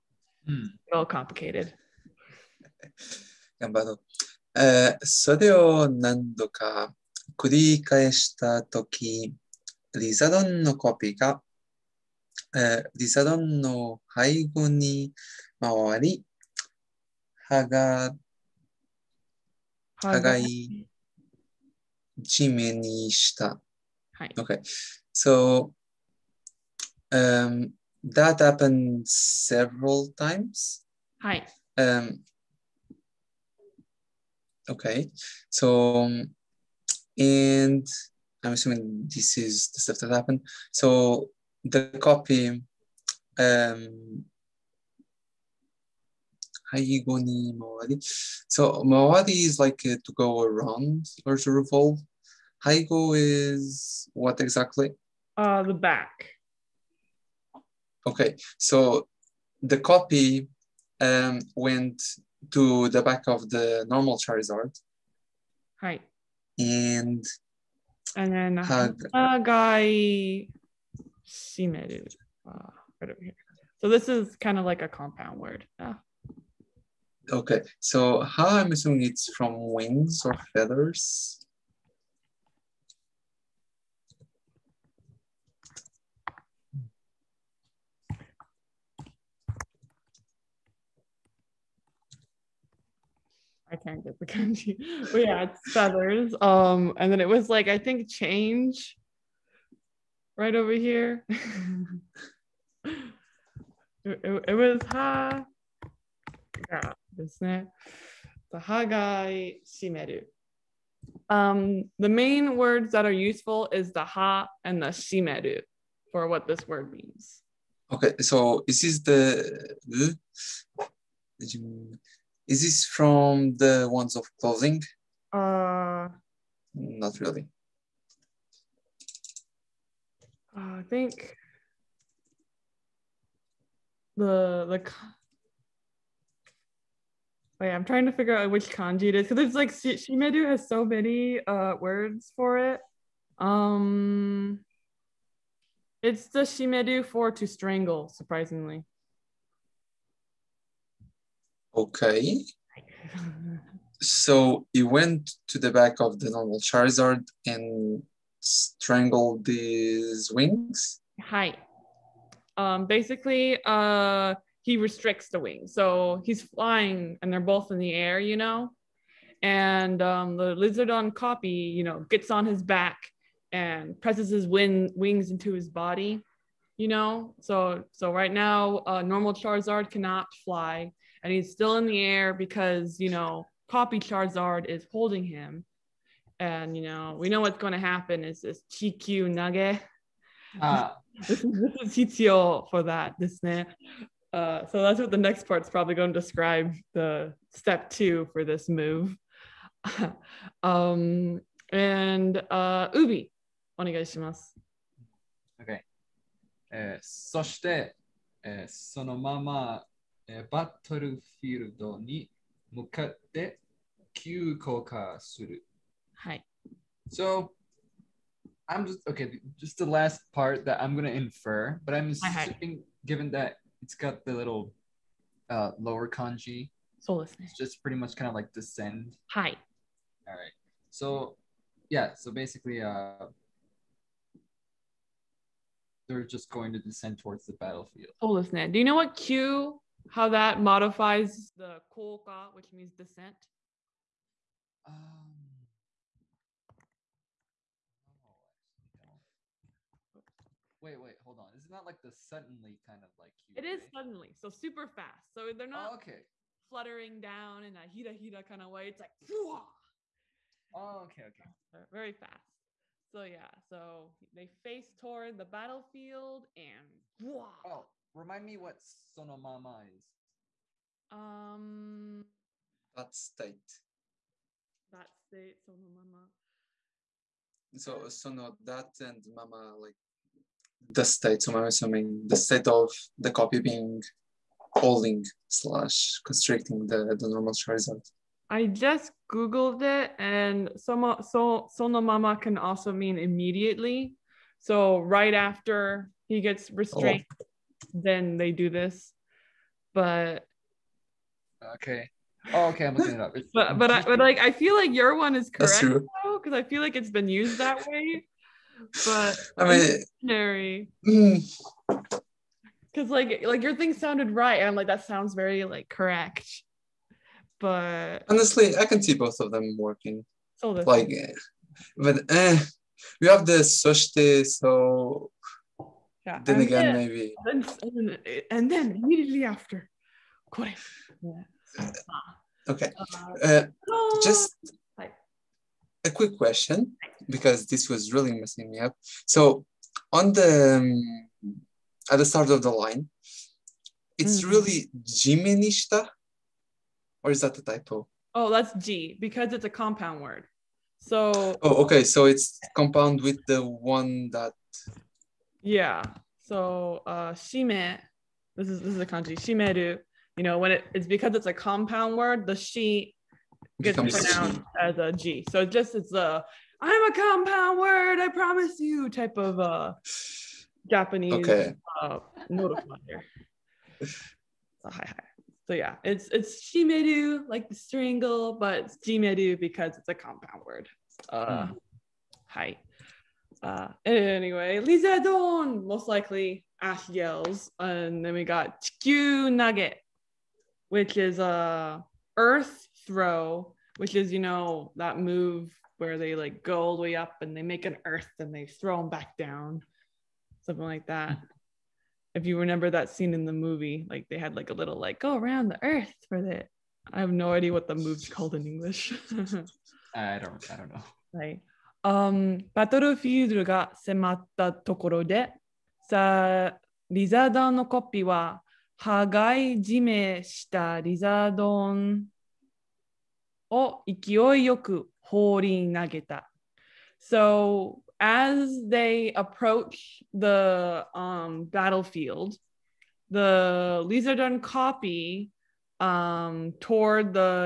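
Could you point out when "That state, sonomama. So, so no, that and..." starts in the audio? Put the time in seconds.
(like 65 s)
274 s.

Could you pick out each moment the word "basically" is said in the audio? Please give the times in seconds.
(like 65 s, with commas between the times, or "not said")
162 s, 232 s.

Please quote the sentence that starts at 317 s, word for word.
But honestly, I can see both of them working.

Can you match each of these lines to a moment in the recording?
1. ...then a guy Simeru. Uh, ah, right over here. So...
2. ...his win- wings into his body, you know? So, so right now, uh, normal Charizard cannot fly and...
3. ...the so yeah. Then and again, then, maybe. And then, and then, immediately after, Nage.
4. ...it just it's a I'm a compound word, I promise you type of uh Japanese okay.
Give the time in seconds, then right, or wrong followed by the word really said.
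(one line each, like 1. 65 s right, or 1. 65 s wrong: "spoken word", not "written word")
1. 68 s right
2. 174 s right
3. 323 s wrong: "Koresh", not "Nage"
4. 365 s right.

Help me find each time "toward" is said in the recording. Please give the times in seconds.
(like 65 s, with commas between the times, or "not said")
237 s, 264 s, 436 s.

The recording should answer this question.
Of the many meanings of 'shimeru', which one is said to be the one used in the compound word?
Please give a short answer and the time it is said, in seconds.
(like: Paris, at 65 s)
to strangle, at 147 s.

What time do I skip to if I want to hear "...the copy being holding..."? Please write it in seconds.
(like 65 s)
283 s.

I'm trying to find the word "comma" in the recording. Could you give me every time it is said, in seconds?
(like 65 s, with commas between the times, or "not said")
not said.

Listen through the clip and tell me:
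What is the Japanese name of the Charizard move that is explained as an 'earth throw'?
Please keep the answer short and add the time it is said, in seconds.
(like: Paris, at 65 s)
Chikyu Nage, at 388 s.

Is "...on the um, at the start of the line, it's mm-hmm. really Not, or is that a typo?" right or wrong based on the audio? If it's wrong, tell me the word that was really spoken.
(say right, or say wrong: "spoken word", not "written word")
wrong: "Jimenista", not "Not".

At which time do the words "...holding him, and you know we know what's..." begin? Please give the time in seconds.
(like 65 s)
184 s.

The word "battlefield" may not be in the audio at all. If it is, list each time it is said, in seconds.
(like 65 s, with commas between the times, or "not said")
237 s, 265 s, 431 s.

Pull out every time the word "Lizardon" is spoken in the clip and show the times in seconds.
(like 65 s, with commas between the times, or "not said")
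170 s, 384 s, 434 s.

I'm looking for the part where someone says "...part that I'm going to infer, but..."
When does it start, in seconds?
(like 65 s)
220 s.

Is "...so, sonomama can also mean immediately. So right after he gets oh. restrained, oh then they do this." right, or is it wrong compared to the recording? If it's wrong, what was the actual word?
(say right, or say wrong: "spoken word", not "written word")
right.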